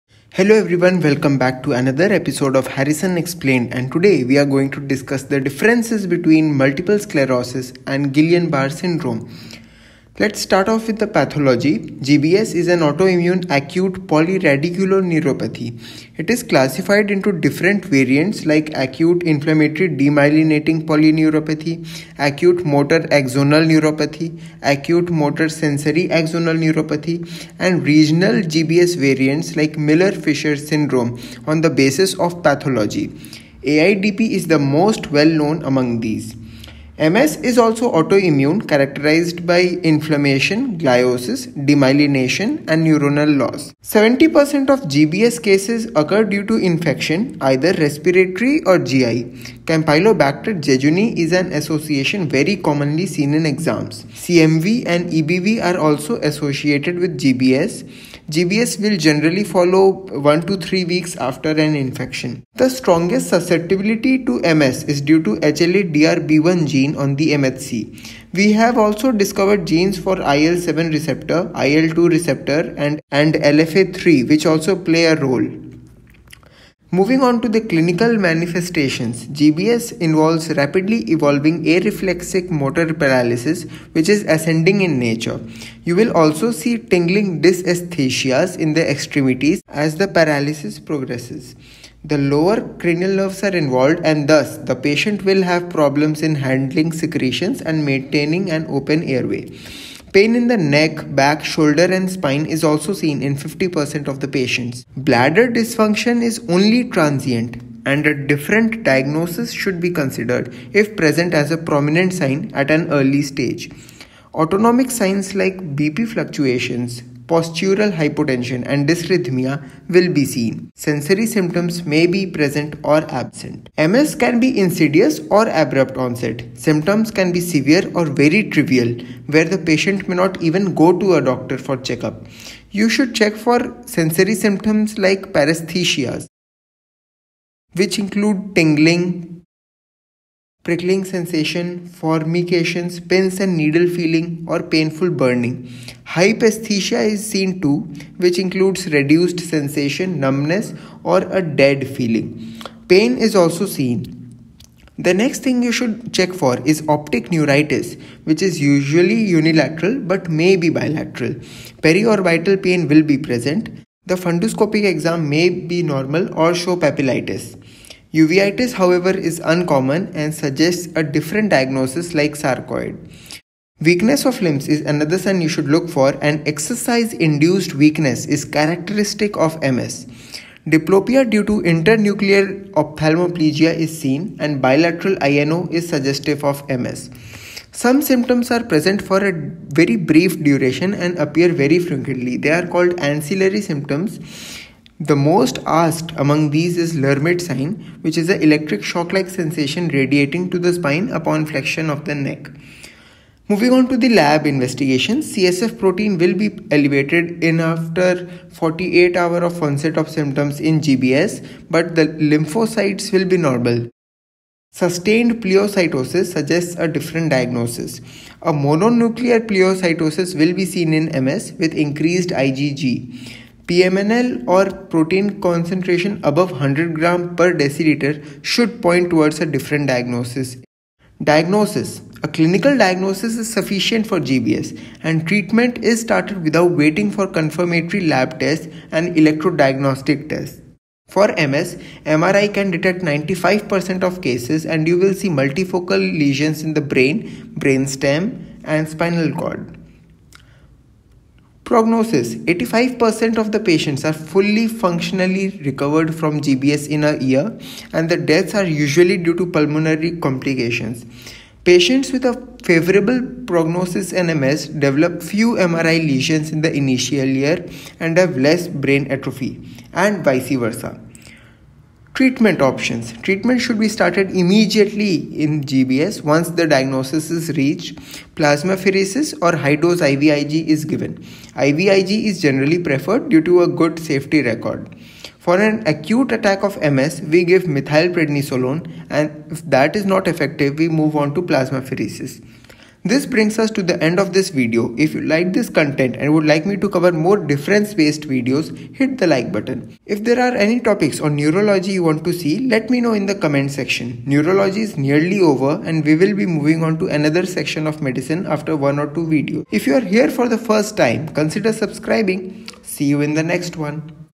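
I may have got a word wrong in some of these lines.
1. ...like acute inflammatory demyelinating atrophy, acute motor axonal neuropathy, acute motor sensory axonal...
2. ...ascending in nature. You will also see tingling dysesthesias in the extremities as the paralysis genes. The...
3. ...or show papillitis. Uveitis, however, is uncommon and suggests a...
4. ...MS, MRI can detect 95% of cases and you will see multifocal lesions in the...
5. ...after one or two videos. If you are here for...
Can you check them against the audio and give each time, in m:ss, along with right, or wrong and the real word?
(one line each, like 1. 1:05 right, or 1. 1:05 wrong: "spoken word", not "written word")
1. 0:18 wrong: "polyneuropathy", not "atrophy"
2. 1:24 wrong: "progresses", not "genes"
3. 2:46 right
4. 4:01 right
5. 5:08 right.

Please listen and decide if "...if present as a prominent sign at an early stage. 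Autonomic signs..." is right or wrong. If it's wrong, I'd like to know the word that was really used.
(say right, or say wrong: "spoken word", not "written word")
right.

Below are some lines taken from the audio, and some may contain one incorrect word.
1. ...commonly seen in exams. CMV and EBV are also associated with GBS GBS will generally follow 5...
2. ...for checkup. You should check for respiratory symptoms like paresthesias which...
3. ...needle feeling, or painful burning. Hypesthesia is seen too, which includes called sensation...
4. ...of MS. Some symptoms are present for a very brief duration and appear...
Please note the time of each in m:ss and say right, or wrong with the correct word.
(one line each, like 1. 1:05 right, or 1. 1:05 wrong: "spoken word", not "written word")
1. 0:52 wrong: "1", not "5"
2. 2:11 wrong: "sensory", not "respiratory"
3. 2:23 wrong: "reduced", not "called"
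4. 3:06 right.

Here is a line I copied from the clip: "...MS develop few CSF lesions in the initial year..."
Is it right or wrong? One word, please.
wrong.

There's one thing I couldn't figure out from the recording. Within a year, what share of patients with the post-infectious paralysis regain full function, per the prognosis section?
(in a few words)
85%.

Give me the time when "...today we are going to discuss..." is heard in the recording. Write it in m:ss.
0:03.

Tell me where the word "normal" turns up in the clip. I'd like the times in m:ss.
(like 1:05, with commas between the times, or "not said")
2:45, 3:33.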